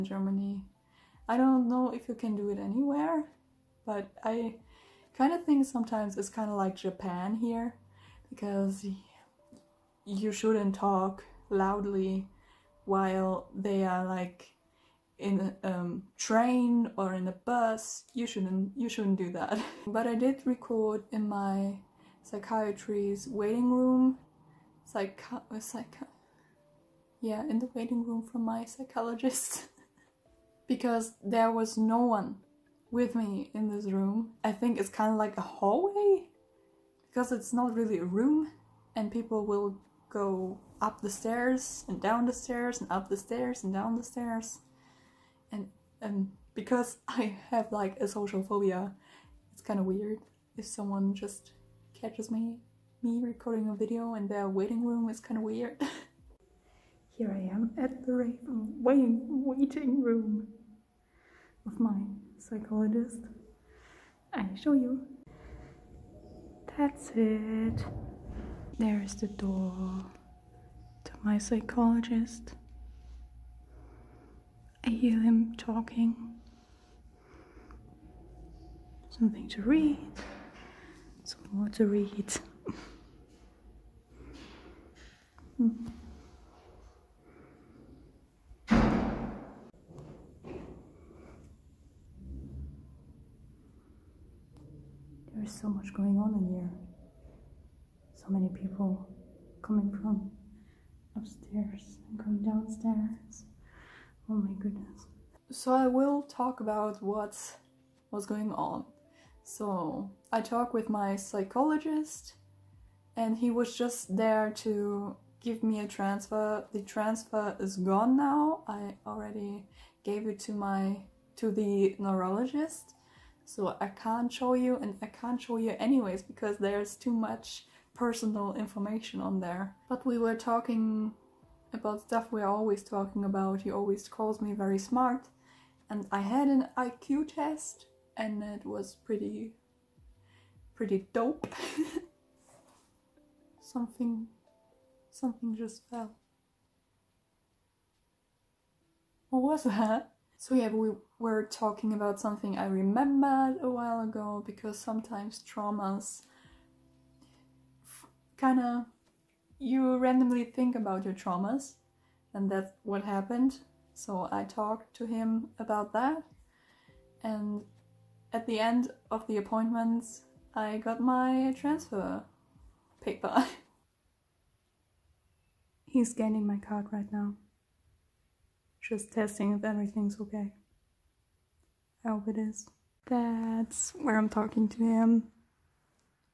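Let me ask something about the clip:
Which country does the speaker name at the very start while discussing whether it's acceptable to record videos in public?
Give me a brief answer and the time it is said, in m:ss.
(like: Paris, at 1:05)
Germany, at 0:00.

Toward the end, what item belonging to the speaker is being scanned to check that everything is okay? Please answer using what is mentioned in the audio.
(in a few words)
card.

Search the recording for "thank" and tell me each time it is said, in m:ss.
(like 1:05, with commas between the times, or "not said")
not said.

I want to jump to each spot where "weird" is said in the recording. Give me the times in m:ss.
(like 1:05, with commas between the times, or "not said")
0:49, 0:55.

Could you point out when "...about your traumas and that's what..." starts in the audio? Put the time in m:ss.
2:40.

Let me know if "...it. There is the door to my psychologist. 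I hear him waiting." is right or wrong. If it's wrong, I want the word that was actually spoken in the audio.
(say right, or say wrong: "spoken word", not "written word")
wrong: "talking", not "waiting".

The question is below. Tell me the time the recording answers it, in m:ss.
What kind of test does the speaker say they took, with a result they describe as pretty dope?
2:16.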